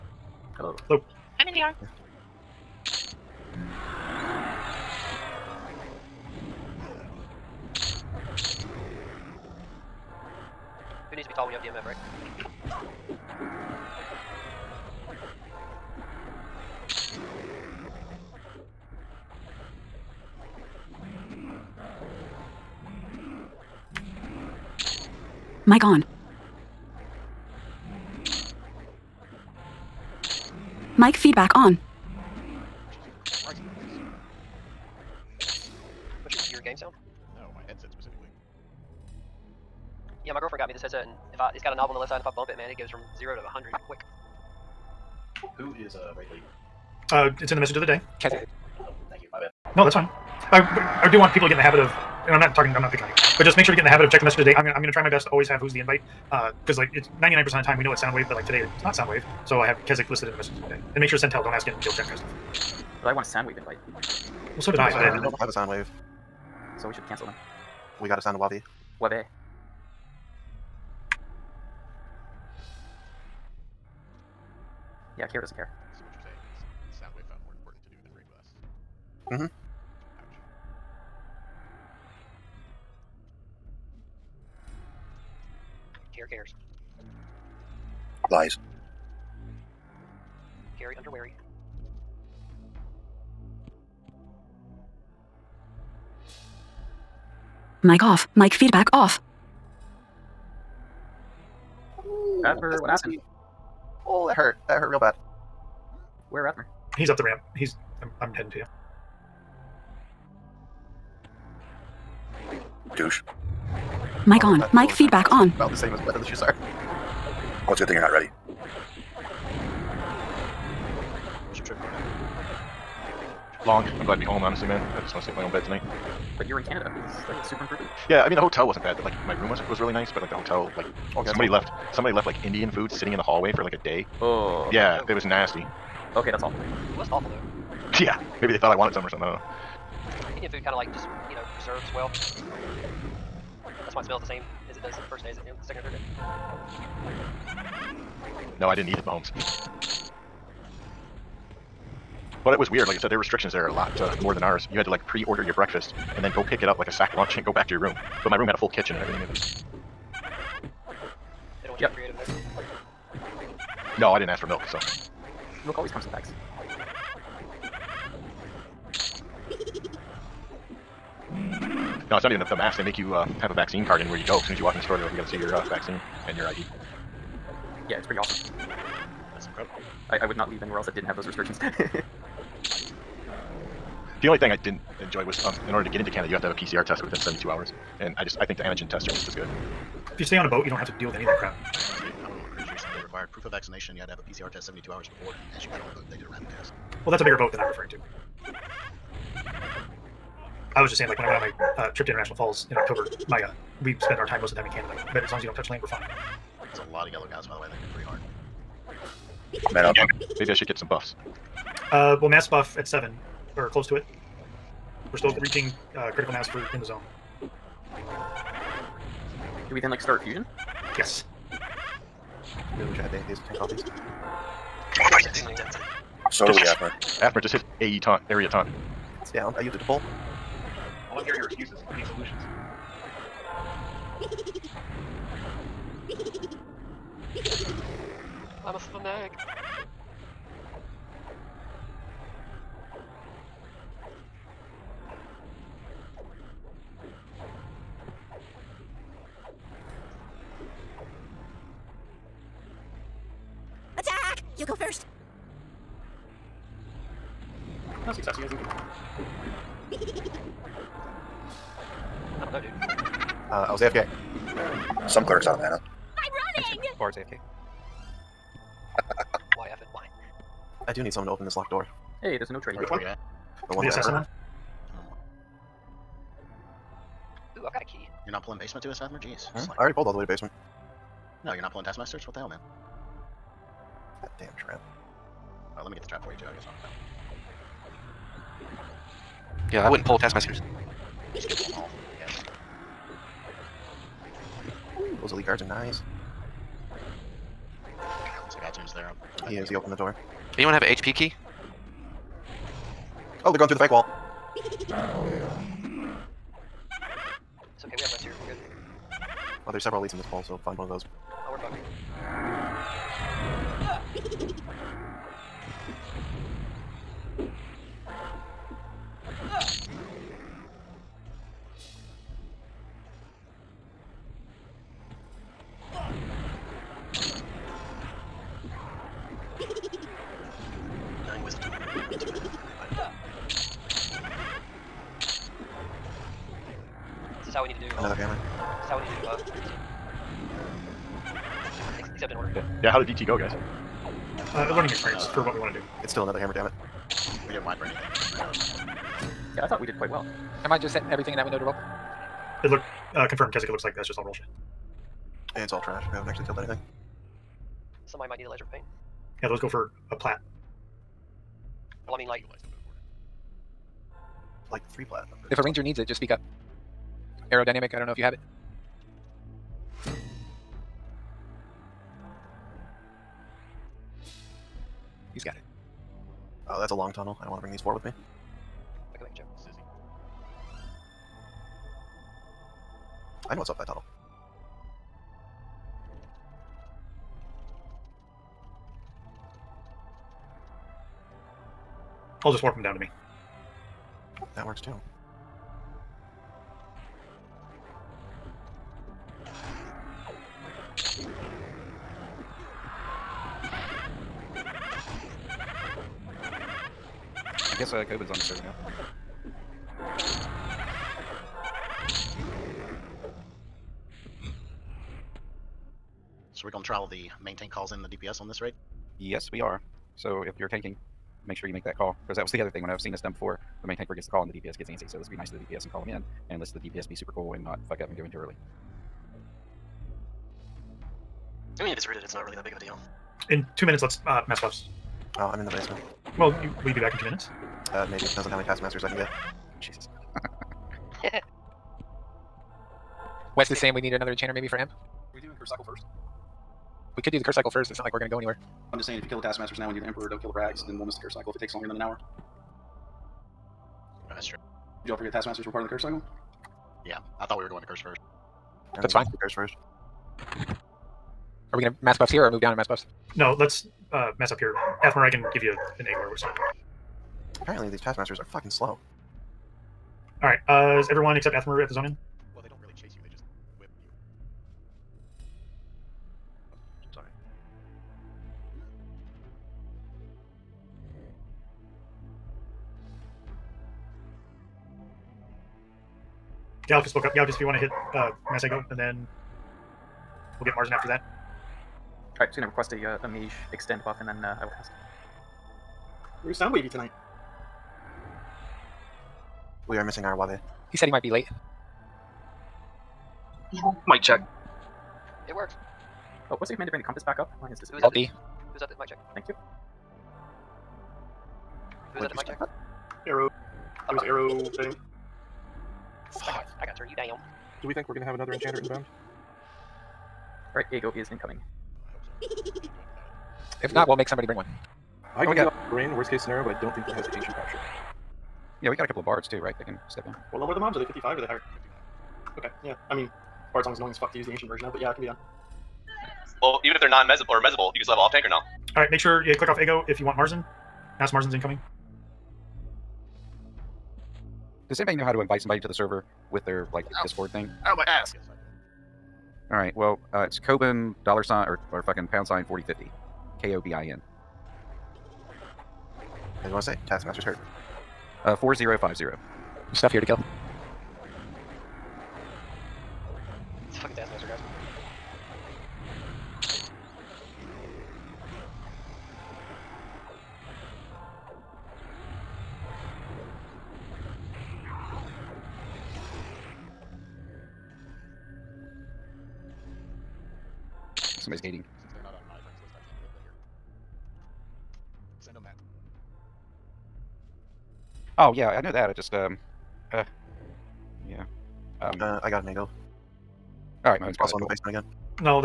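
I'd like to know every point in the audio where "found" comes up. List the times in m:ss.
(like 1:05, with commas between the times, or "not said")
1:17.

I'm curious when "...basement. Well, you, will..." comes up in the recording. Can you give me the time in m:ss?
7:15.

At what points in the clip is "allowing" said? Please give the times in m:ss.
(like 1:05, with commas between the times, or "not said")
not said.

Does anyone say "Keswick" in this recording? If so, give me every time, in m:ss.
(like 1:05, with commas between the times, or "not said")
0:59, 5:53.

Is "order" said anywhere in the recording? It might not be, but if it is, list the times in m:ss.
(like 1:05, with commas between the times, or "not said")
2:35, 3:05.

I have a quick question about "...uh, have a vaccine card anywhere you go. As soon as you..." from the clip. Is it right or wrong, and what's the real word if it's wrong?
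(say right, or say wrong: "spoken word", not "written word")
right.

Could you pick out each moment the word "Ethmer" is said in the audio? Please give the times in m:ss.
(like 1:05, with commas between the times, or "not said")
7:45, 7:51.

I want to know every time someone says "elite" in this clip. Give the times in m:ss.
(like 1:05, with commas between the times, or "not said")
4:55, 5:10.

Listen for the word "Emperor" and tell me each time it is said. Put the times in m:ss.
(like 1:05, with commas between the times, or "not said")
7:30.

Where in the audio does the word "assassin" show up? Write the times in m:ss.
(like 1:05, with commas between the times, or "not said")
4:33.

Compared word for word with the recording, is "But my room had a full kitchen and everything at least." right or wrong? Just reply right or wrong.
right.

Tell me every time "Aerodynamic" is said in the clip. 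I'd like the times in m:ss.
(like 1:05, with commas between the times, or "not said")
6:07.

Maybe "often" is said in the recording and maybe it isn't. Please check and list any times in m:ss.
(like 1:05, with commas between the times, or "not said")
not said.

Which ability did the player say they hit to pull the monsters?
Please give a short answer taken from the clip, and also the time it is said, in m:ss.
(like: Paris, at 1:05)
AE taunt, at 3:47.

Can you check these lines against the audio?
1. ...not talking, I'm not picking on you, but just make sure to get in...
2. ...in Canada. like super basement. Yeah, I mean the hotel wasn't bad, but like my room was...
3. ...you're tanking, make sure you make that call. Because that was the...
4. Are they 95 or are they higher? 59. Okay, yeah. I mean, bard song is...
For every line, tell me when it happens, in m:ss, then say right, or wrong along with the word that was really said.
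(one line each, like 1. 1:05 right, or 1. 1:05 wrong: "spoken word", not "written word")
1. 0:52 right
2. 2:06 wrong: "improvement", not "basement"
3. 7:00 right
4. 8:50 wrong: "55", not "95".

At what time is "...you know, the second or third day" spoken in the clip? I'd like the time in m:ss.
2:25.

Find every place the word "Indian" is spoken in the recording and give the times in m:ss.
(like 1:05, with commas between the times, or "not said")
2:12, 2:20.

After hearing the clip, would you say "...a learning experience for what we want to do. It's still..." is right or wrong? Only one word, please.
right.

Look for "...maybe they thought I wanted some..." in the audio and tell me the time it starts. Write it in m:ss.
2:18.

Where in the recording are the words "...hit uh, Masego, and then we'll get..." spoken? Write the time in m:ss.
8:07.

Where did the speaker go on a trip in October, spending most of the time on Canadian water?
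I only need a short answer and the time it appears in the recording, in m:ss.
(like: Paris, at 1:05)
International Falls, at 3:22.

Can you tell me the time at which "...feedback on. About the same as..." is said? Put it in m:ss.
1:54.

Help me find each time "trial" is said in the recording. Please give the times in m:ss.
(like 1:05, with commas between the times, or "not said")
6:56.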